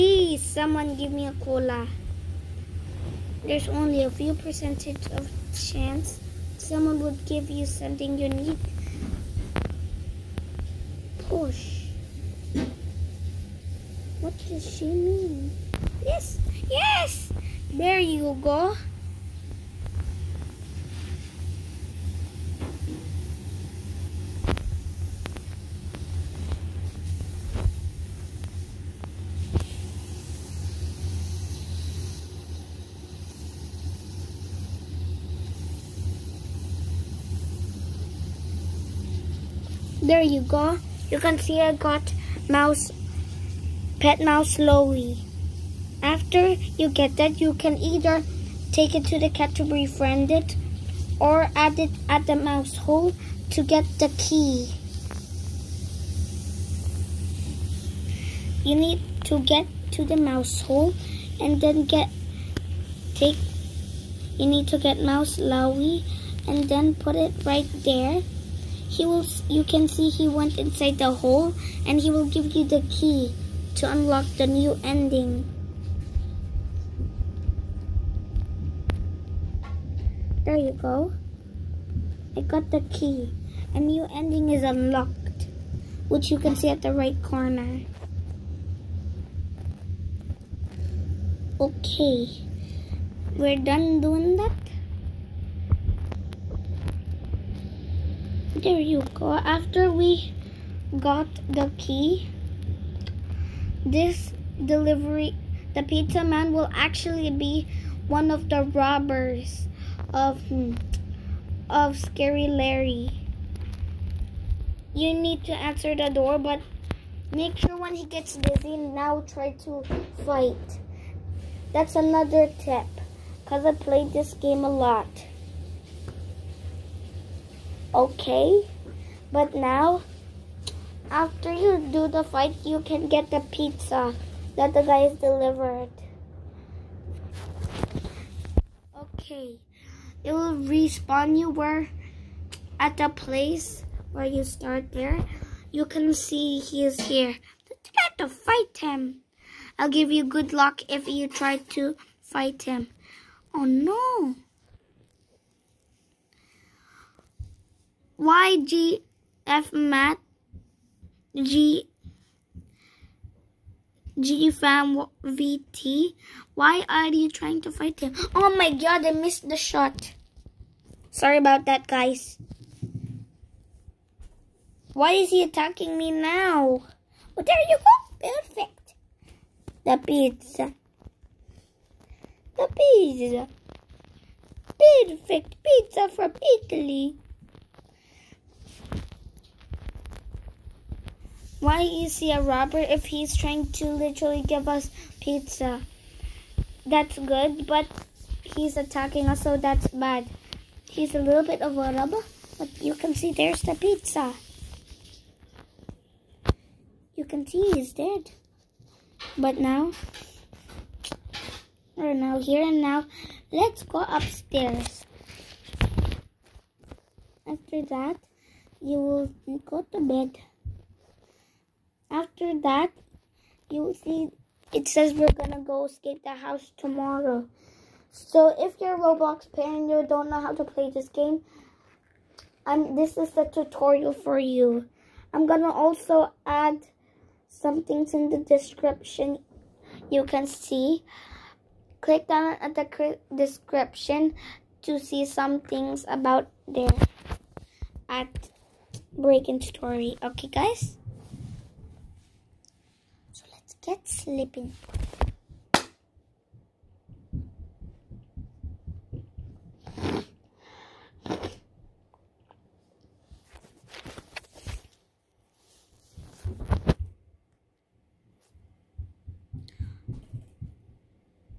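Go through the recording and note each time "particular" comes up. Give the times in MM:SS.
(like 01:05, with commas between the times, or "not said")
not said.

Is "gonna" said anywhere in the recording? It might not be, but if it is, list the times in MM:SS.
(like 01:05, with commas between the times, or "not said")
03:45, 03:55.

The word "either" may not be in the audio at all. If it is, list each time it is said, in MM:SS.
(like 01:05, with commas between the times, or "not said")
00:47.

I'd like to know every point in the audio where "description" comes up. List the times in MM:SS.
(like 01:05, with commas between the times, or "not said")
03:58, 04:03.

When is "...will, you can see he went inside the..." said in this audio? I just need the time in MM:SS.
01:09.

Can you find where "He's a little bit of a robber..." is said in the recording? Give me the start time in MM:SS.
03:20.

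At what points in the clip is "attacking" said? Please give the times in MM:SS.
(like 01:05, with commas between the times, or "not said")
02:55, 03:18.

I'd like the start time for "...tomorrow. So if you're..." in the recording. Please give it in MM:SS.
03:46.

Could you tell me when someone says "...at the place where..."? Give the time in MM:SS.
02:22.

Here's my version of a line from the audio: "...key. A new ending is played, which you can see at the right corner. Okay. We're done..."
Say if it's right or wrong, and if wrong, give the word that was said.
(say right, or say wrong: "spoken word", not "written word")
wrong: "unlocked", not "played".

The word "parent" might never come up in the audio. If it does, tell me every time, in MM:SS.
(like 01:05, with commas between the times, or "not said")
03:49.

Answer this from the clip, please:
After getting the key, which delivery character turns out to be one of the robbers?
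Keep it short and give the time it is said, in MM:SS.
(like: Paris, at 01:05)
the pizza man, at 01:45.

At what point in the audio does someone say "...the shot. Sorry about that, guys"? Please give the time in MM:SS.
02:49.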